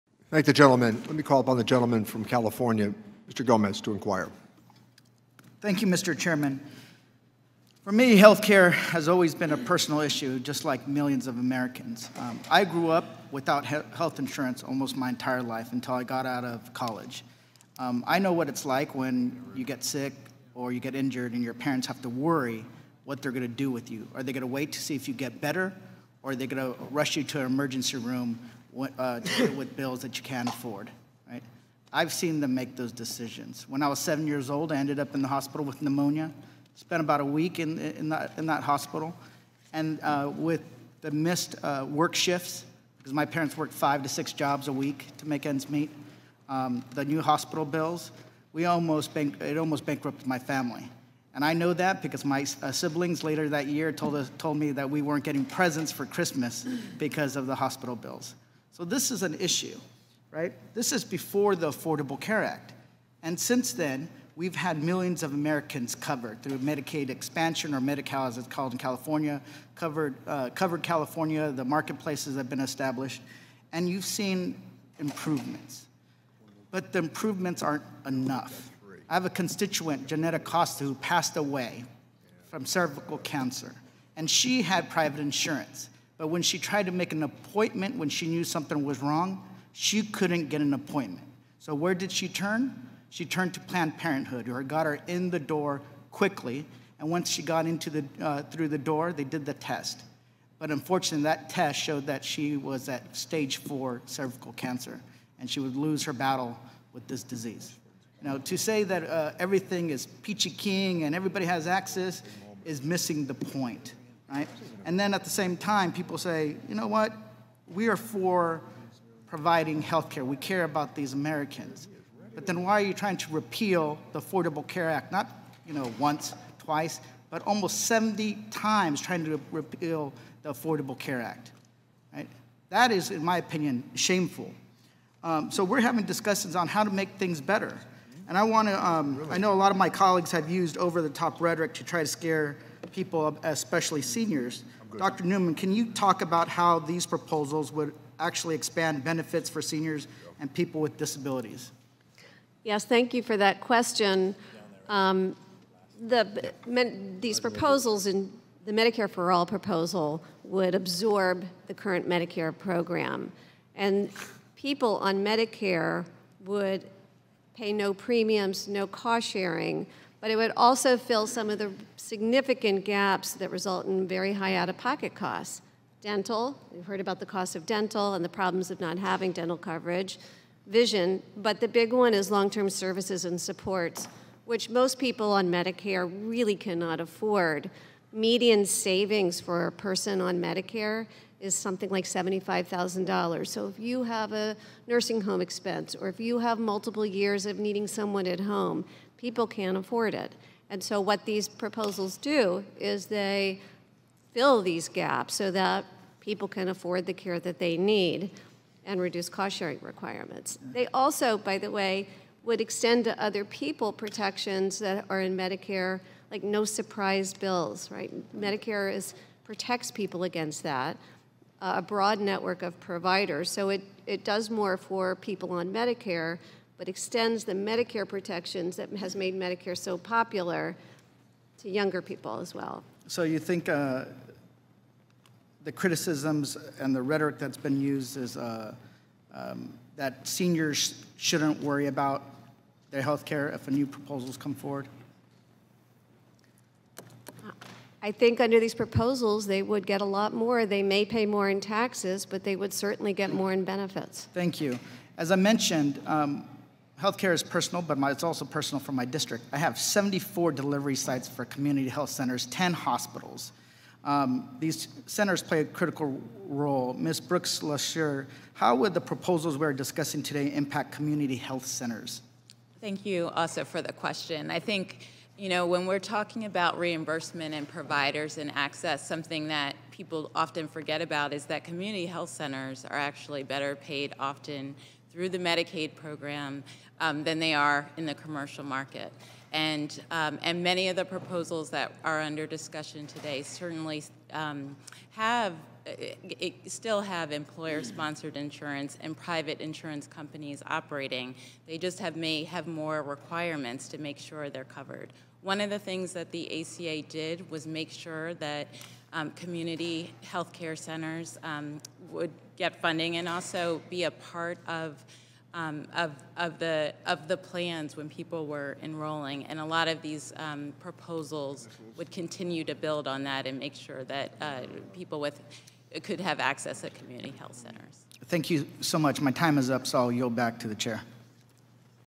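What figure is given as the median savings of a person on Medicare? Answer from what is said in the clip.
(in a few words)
$75,000.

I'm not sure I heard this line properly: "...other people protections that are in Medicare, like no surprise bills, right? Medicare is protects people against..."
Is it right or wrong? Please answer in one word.
right.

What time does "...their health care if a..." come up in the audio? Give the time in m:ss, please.
4:02.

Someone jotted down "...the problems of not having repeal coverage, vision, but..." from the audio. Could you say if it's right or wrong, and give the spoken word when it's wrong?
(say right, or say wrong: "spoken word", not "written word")
wrong: "dental", not "repeal".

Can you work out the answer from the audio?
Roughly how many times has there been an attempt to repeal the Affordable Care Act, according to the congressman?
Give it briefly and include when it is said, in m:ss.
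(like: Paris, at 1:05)
70, at 2:07.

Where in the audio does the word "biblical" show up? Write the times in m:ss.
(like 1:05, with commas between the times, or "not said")
not said.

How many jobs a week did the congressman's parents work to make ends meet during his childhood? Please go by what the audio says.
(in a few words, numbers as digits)
5 to 6.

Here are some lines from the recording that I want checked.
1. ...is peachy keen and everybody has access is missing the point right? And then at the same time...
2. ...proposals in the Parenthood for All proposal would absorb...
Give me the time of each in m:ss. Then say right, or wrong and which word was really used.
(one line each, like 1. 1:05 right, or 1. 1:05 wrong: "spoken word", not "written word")
1. 1:49 right
2. 2:37 wrong: "Medicare", not "Parenthood".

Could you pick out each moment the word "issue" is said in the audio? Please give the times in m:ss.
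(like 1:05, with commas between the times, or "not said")
0:09, 0:59.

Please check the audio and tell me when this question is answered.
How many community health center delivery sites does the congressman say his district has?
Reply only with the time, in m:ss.
4:19.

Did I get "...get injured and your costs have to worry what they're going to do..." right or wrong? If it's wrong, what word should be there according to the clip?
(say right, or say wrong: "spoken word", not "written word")
wrong: "parents", not "costs".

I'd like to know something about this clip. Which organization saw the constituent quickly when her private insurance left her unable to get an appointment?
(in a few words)
Planned Parenthood.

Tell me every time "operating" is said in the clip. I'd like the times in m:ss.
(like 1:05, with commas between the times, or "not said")
5:00.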